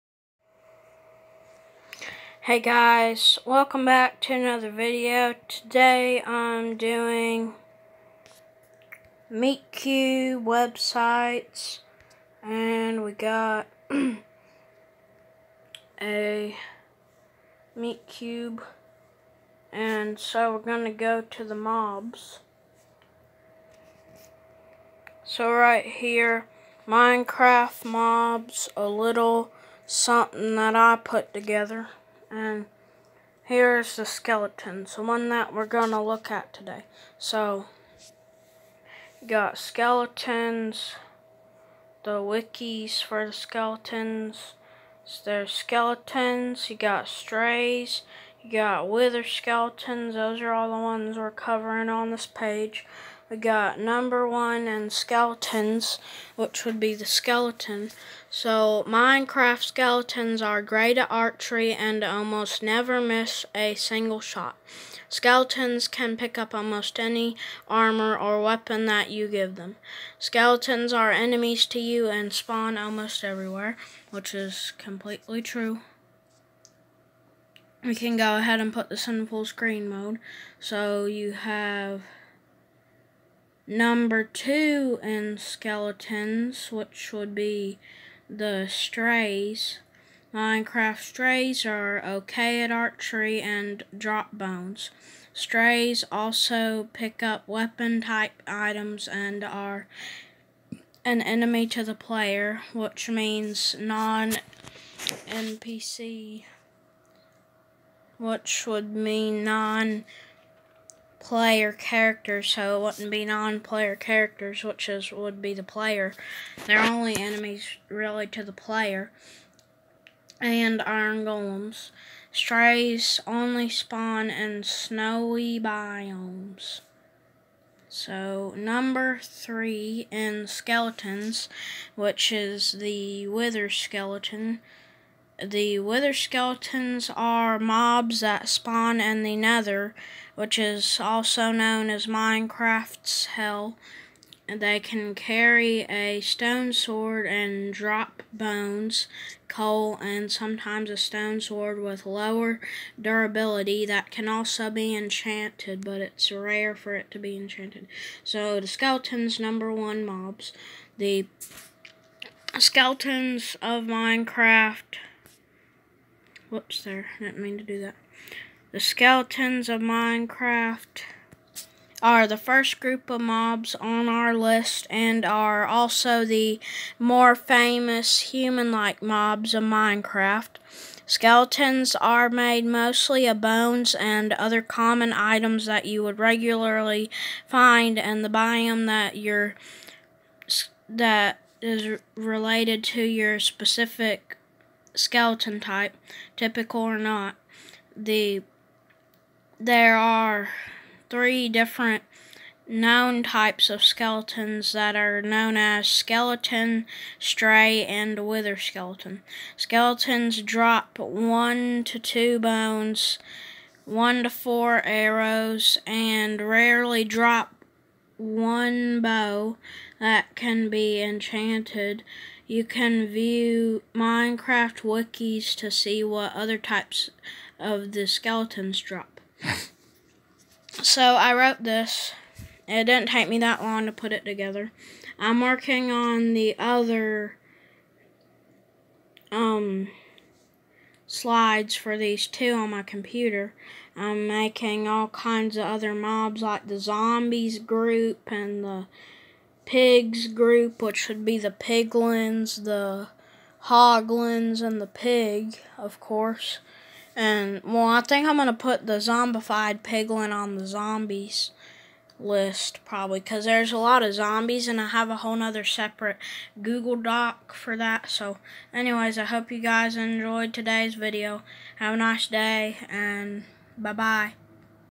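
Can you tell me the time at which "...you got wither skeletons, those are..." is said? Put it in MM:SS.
00:48.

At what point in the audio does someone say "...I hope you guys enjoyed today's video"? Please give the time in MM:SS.
04:29.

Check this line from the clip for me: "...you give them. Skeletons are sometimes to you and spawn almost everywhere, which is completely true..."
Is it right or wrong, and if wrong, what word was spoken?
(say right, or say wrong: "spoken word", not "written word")
wrong: "enemies", not "sometimes".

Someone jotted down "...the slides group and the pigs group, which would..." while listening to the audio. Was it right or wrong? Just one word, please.
wrong.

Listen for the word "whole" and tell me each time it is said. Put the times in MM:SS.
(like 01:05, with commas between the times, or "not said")
04:25.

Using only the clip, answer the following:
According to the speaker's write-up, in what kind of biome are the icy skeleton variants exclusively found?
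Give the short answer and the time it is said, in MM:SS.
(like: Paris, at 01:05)
Snowy biomes, at 02:04.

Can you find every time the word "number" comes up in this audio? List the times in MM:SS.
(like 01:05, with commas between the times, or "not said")
00:53, 01:23, 02:08, 02:39.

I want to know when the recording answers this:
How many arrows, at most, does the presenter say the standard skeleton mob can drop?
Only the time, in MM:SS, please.
03:33.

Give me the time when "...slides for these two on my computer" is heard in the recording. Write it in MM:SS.
04:01.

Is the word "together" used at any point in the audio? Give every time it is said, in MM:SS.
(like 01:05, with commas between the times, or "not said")
00:31, 03:54.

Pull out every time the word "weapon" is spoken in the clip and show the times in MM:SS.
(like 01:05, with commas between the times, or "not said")
01:08, 01:37.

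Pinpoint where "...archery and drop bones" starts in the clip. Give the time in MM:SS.
01:32.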